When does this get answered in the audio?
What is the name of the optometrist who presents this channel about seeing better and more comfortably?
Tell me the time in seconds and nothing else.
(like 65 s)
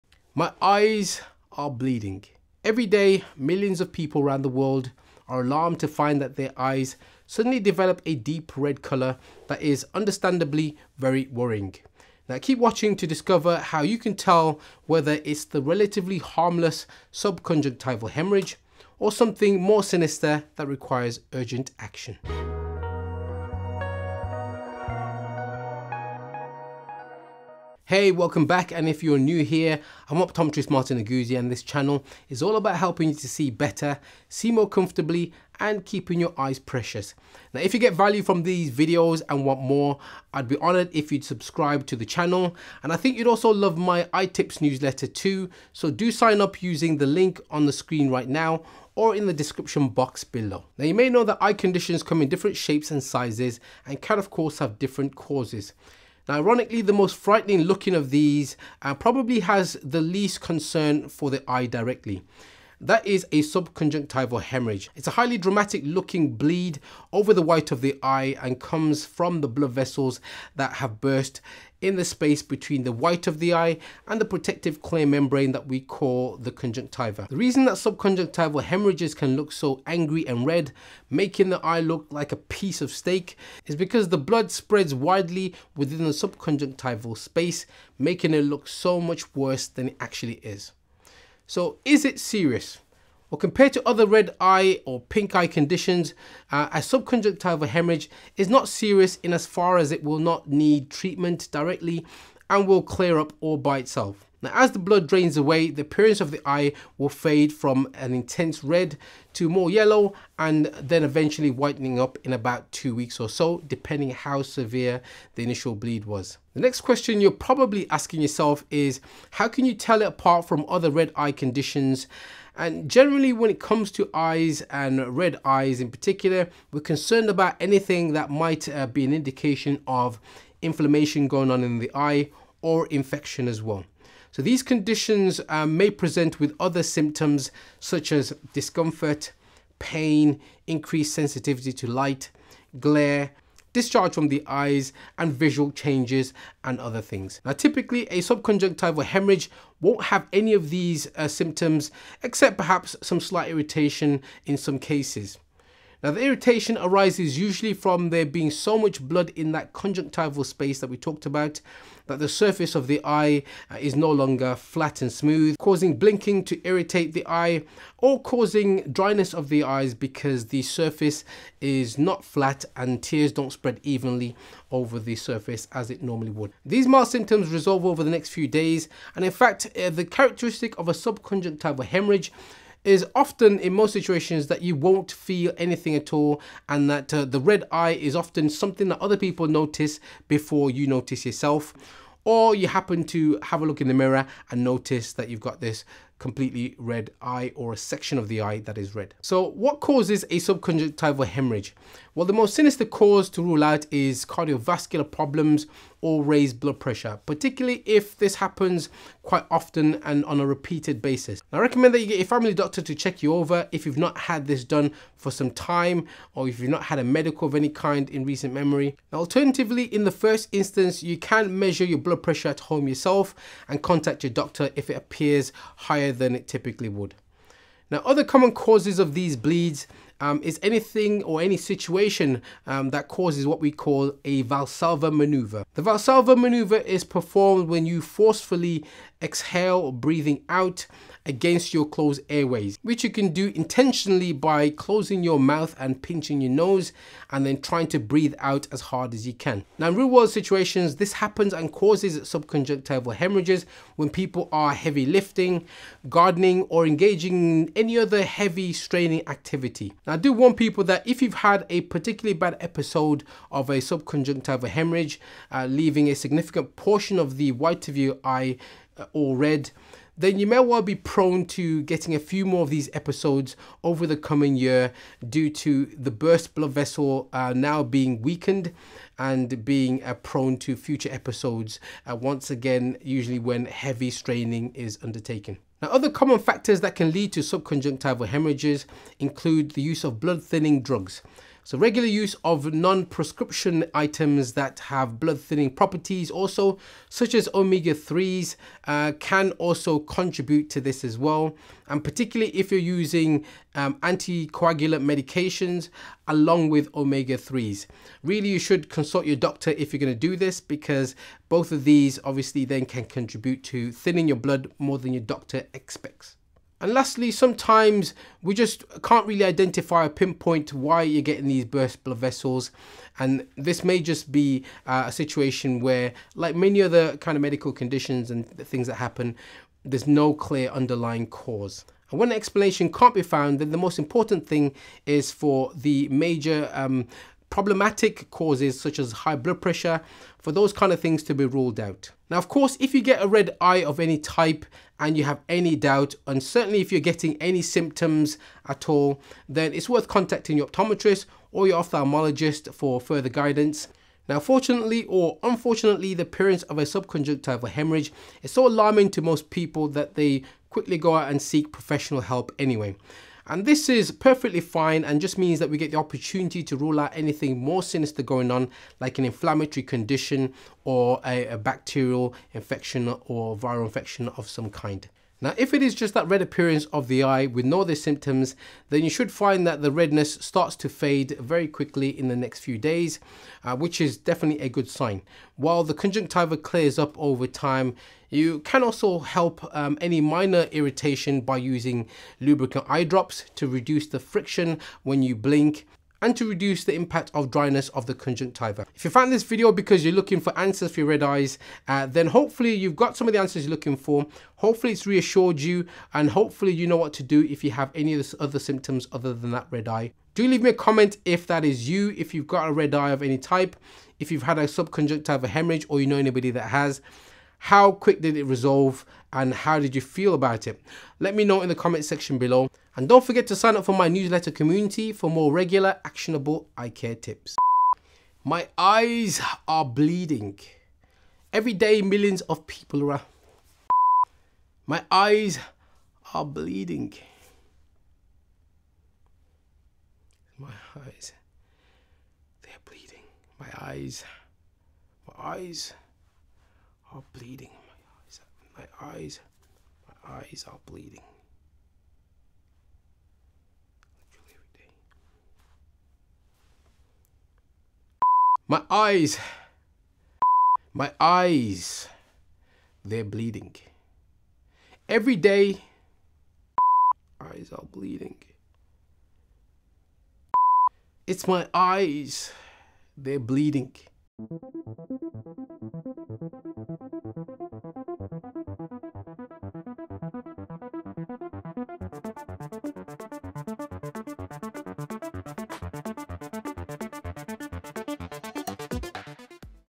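30 s.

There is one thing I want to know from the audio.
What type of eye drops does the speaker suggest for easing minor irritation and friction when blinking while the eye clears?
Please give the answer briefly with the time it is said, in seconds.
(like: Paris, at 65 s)
Lubricant eye drops, at 392 s.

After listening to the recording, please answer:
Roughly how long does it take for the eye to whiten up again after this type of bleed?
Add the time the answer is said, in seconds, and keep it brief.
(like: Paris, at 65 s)
2 weeks, at 112 s.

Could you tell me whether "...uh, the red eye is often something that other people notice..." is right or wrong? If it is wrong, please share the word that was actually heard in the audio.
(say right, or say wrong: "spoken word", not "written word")
right.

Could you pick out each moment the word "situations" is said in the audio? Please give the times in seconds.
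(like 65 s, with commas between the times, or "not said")
183 s, 231 s, 250 s, 325 s.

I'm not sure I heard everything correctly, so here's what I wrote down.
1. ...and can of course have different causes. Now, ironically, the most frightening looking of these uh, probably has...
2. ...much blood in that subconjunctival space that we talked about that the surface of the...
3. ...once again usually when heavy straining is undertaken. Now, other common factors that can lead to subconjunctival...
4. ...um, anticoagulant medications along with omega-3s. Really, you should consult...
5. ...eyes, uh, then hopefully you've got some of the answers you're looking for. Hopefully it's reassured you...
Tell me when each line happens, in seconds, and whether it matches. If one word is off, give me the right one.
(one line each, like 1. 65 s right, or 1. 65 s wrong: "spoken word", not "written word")
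1. 53 s right
2. 158 s wrong: "conjunctival", not "subconjunctival"
3. 282 s right
4. 303 s right
5. 401 s right.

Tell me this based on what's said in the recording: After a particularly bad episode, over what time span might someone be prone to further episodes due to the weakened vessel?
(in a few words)
The coming year.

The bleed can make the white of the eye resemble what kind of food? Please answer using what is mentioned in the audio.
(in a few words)
A piece of steak.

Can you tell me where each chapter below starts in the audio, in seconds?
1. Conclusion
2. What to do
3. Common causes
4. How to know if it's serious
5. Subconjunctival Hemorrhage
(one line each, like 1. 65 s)
1. 398 s
2. 341 s
3. 198 s
4. 90 s
5. 50 s.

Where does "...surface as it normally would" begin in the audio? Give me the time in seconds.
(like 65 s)
175 s.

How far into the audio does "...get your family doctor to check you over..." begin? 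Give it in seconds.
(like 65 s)
212 s.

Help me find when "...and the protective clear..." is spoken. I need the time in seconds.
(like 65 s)
74 s.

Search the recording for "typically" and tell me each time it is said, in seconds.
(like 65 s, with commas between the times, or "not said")
147 s, 226 s.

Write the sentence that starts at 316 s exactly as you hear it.
And lastly, sometimes we just can't really identify or pinpoint why you're getting these burst blood vessels.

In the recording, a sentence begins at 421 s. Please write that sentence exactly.
Let me know in the comment section below.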